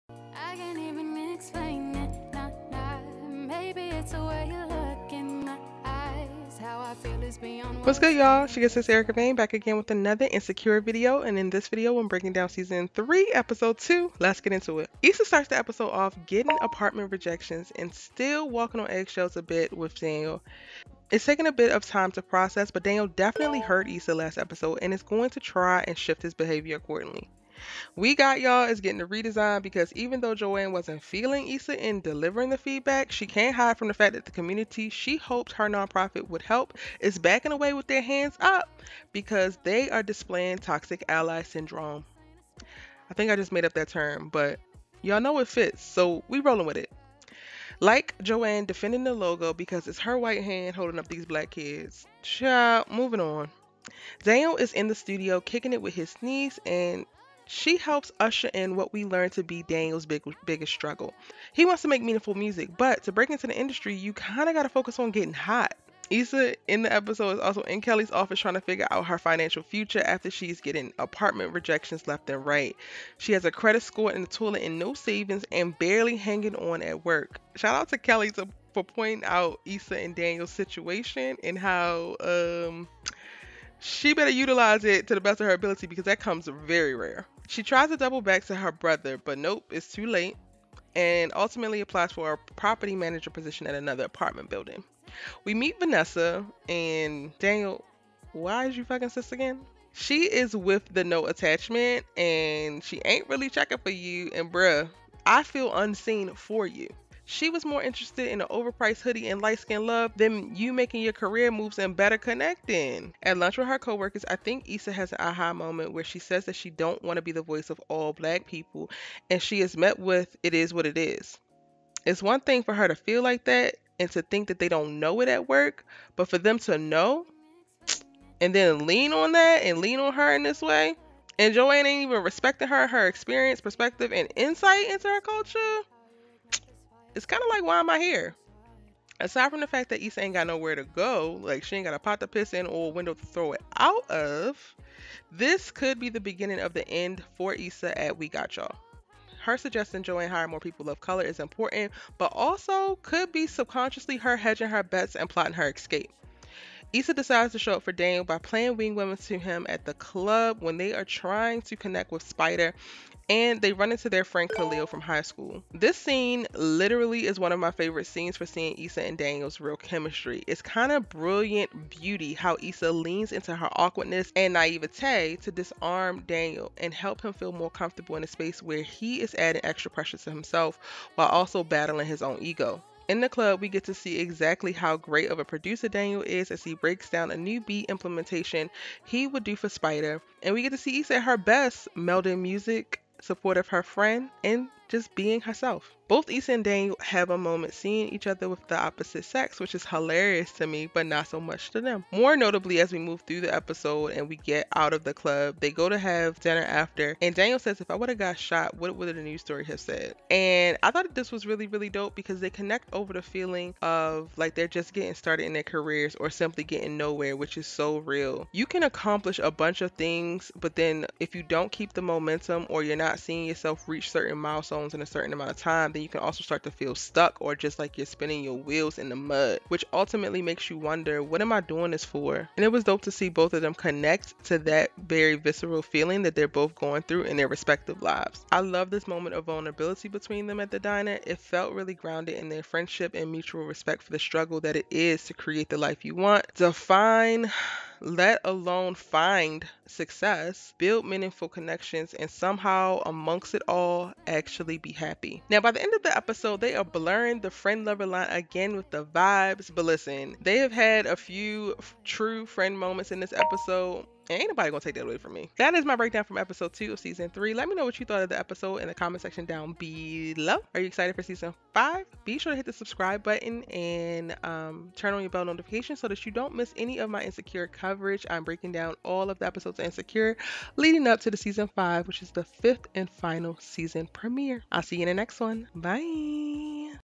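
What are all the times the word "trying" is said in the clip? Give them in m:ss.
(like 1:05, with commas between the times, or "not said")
1:08, 2:41.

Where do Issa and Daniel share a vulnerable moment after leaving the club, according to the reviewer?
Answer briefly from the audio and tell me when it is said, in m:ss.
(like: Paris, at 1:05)
the diner, at 4:00.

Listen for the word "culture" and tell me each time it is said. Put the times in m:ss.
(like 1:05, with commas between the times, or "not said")
2:15.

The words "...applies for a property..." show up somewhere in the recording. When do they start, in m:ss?
1:31.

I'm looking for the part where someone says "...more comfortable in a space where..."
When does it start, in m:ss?
2:57.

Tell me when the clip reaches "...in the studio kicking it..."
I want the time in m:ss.
0:54.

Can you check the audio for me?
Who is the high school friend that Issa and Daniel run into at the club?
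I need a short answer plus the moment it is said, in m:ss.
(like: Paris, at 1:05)
Khalil, at 2:44.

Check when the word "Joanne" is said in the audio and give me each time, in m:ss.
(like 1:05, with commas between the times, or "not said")
0:30, 0:48, 2:11, 2:30.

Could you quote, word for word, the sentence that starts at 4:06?
Define let alone find success, build meaningful connections, and somehow, amongst it all, actually be happy.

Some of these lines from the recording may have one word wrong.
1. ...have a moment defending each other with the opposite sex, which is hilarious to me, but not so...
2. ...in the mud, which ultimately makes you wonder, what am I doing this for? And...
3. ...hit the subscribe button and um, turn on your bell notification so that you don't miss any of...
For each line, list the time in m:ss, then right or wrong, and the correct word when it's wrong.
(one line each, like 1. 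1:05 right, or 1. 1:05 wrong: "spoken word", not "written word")
1. 3:16 wrong: "seeing", not "defending"
2. 3:48 right
3. 4:32 right.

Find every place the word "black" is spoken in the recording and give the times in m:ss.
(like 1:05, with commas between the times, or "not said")
0:51, 1:58.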